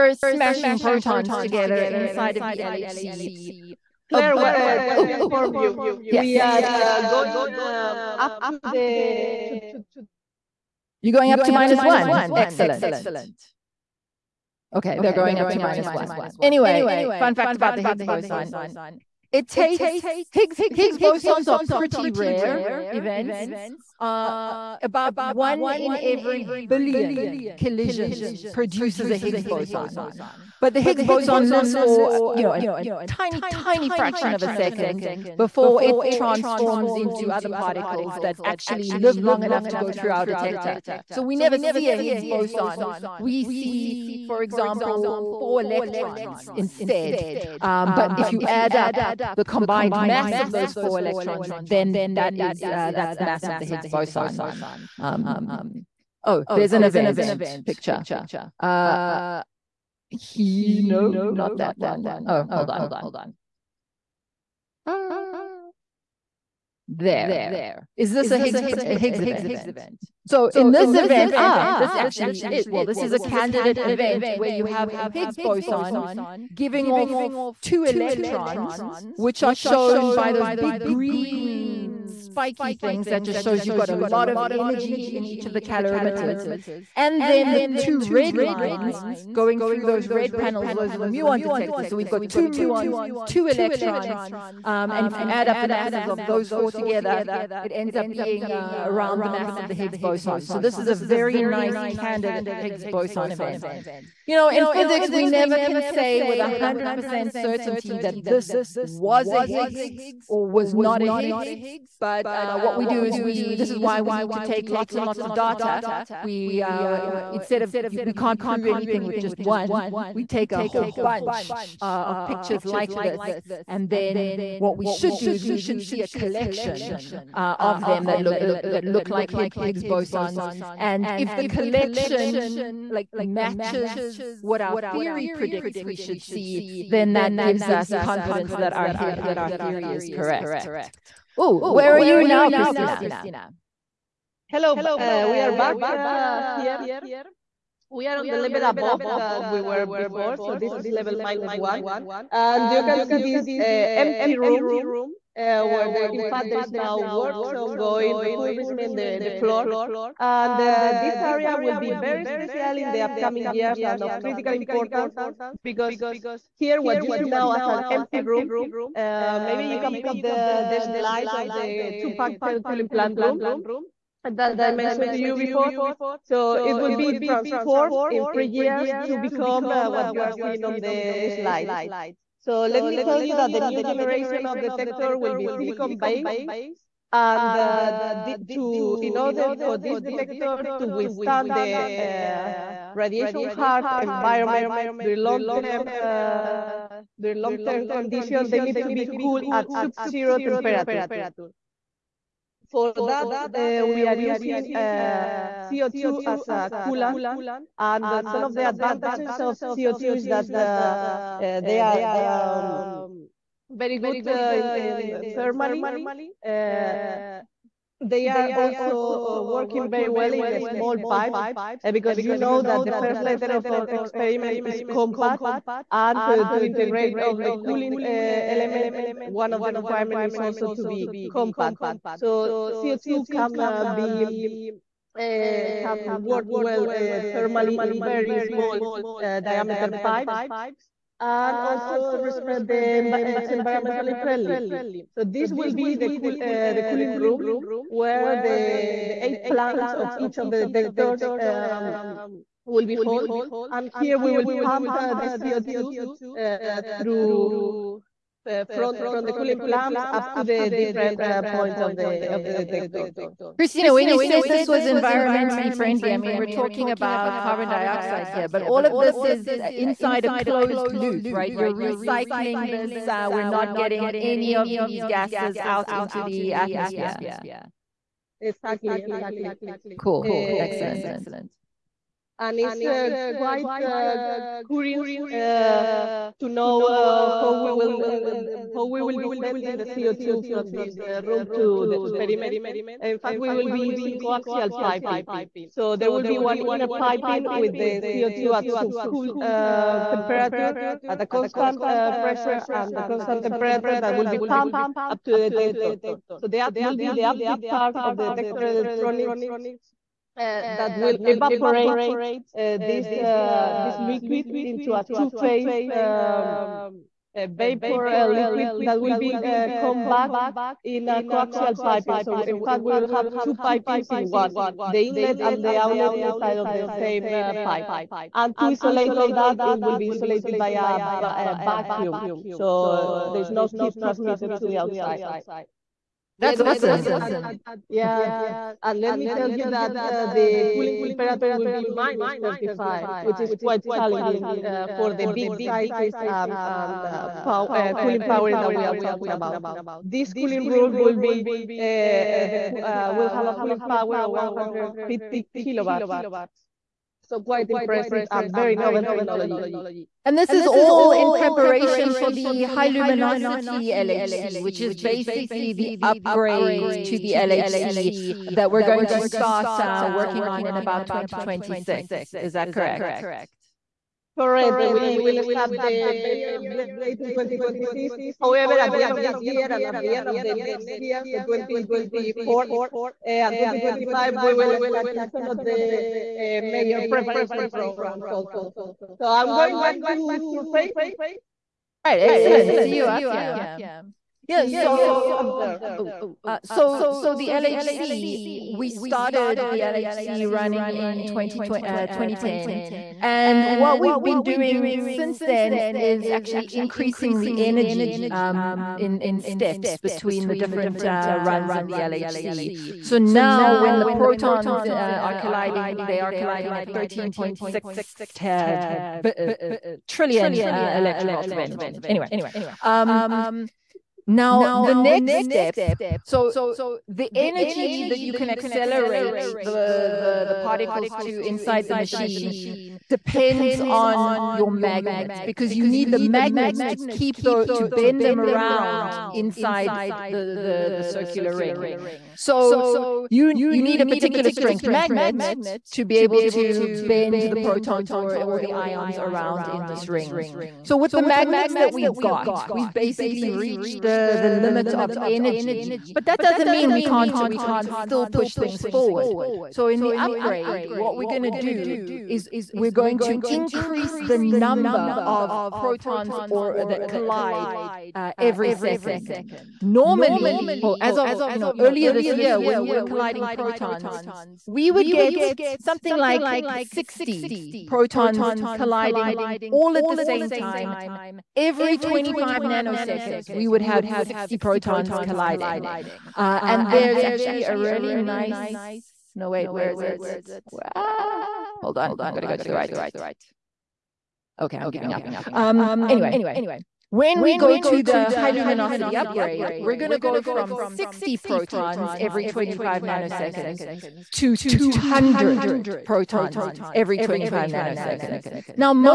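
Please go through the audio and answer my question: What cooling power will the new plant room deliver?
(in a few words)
150 kilowatts.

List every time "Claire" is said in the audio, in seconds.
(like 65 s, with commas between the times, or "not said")
4 s.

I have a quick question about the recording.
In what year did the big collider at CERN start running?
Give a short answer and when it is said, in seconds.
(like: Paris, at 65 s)
2010, at 402 s.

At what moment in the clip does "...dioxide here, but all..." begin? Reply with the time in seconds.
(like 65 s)
267 s.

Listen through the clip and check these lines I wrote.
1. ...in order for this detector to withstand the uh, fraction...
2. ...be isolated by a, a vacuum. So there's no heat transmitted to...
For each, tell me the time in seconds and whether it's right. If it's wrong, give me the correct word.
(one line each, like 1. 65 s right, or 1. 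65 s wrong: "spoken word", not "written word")
1. 189 s wrong: "radiation", not "fraction"
2. 329 s right.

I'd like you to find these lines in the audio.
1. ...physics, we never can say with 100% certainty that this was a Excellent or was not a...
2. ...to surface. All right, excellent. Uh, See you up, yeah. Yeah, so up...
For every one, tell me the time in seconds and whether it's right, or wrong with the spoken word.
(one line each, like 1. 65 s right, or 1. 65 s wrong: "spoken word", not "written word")
1. 104 s wrong: "Higgs", not "Excellent"
2. 390 s right.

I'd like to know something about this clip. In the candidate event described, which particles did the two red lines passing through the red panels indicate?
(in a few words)
Muons.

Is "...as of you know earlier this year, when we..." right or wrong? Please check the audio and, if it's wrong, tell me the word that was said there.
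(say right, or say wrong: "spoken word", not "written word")
right.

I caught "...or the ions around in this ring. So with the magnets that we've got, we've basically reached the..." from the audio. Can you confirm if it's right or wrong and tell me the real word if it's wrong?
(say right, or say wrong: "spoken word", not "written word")
right.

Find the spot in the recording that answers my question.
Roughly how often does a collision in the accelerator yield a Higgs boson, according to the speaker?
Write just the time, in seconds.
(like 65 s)
25 s.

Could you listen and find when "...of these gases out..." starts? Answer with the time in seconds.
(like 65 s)
274 s.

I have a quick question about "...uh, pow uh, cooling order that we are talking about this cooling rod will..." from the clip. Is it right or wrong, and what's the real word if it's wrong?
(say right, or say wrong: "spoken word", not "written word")
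wrong: "power", not "order".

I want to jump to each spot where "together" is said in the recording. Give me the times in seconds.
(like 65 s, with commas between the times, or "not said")
1 s, 96 s.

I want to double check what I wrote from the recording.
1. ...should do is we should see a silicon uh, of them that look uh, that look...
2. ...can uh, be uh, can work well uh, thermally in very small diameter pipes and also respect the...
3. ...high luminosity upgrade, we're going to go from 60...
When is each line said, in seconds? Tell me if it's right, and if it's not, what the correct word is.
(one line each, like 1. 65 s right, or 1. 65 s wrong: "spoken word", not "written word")
1. 124 s wrong: "collection", not "silicon"
2. 233 s right
3. 498 s right.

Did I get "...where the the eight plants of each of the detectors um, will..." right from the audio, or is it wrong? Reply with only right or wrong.
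right.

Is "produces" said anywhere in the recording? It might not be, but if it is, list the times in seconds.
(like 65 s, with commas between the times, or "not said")
28 s.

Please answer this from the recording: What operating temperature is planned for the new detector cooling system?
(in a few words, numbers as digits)
-35.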